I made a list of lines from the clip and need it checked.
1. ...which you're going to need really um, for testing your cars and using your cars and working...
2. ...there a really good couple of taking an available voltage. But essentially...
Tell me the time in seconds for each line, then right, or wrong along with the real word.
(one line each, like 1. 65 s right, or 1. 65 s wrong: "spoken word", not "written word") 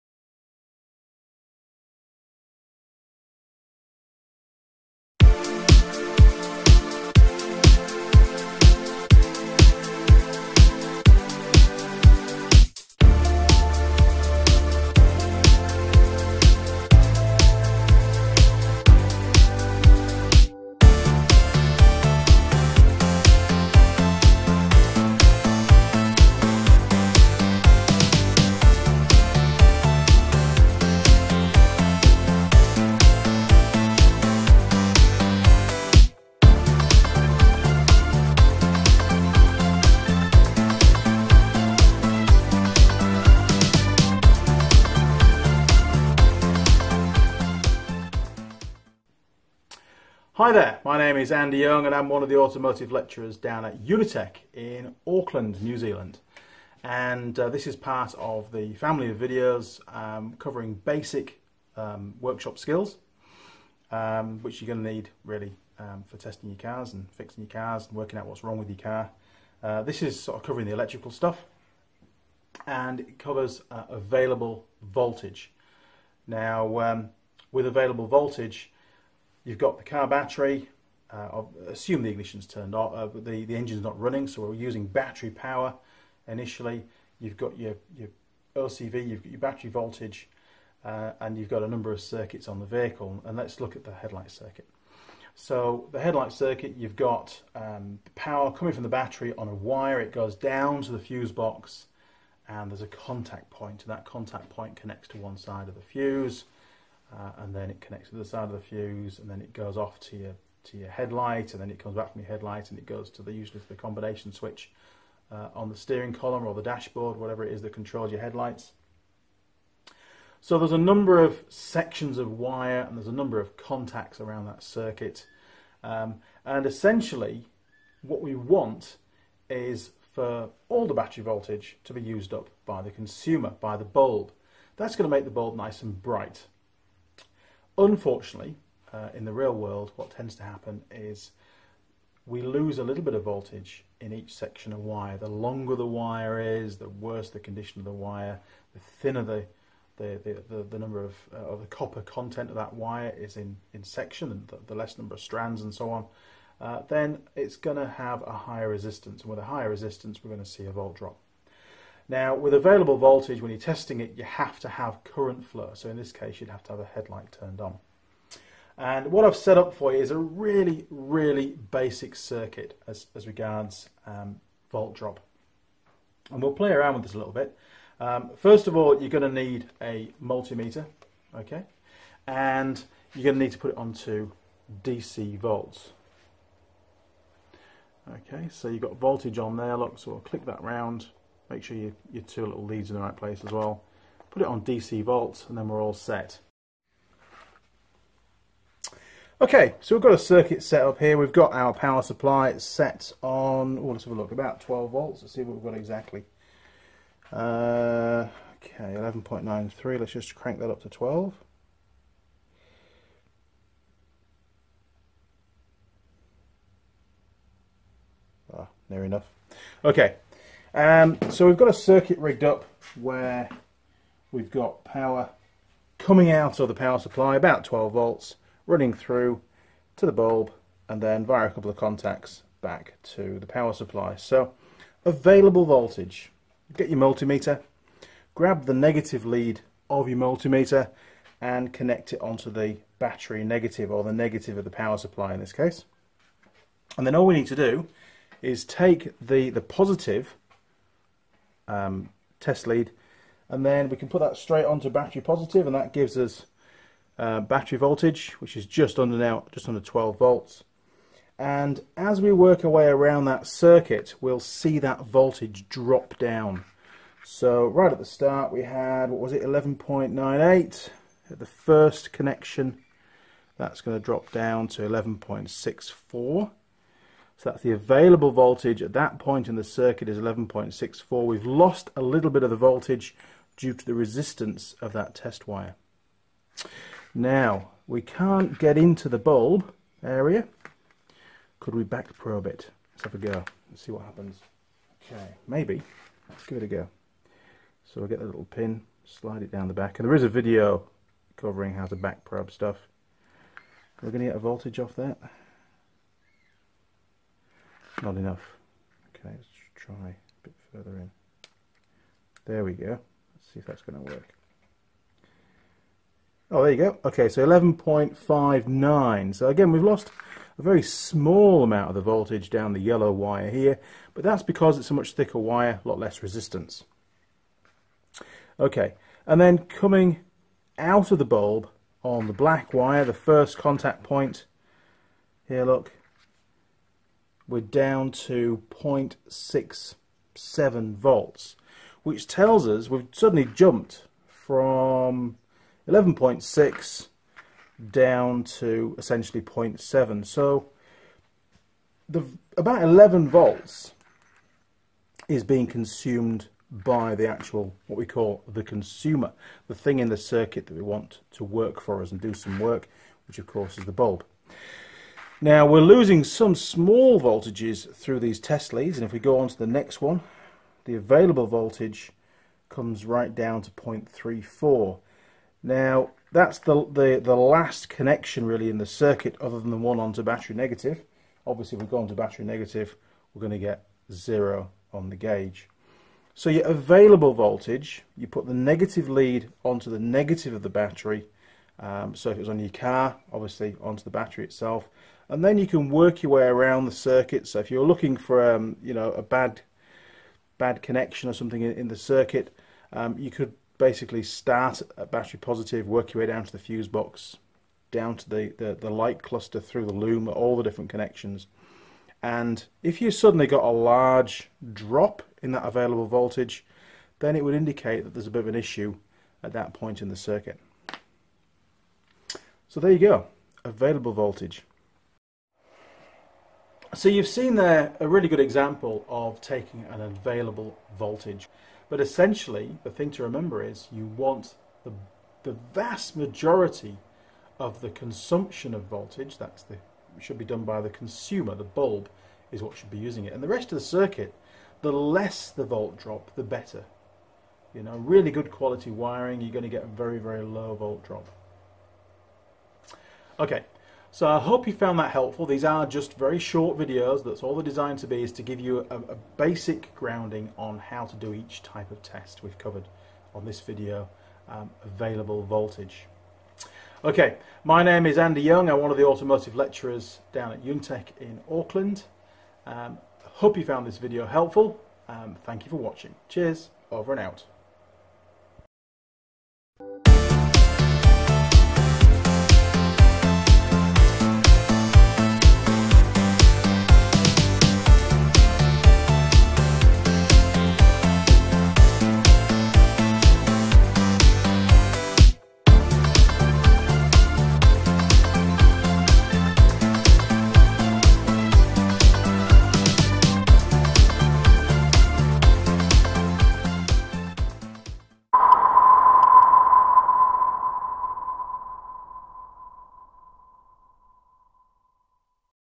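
1. 64 s wrong: "fixing", not "using"
2. 427 s wrong: "example", not "couple".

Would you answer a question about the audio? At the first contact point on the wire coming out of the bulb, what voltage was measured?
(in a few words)
0.67 volts.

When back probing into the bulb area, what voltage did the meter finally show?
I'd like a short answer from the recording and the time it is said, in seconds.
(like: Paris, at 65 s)
11.59, at 317 s.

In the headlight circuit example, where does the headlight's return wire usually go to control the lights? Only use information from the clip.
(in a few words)
combination switch.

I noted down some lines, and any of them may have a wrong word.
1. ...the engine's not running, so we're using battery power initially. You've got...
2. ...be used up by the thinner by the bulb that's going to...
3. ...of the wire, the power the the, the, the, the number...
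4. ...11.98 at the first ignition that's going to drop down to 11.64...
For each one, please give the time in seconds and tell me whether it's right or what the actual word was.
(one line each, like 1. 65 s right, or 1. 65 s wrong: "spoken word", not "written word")
1. 83 s right
2. 131 s wrong: "consumer", not "thinner"
3. 147 s wrong: "thinner", not "power"
4. 269 s wrong: "connection", not "ignition".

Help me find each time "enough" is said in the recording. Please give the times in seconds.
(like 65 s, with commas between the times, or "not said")
219 s, 308 s.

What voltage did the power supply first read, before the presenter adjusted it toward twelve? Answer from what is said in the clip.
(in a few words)
11.93.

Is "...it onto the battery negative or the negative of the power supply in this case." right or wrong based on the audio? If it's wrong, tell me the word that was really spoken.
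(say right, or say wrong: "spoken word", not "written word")
right.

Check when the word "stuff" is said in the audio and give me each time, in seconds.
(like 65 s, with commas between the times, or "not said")
71 s, 302 s.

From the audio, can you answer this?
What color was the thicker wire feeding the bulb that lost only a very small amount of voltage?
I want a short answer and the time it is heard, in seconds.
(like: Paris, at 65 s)
yellow, at 322 s.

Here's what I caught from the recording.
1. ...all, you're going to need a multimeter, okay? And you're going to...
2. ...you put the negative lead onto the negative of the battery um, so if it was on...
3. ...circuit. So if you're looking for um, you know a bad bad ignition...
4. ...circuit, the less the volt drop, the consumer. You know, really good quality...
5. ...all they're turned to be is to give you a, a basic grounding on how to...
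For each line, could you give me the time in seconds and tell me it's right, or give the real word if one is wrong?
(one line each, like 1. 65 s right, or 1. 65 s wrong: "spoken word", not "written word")
1. 178 s right
2. 388 s right
3. 396 s wrong: "connection", not "ignition"
4. 443 s wrong: "better", not "consumer"
5. 457 s wrong: "designed", not "turned".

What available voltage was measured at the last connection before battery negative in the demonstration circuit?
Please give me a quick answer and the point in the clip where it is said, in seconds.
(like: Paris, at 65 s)
0.34, at 373 s.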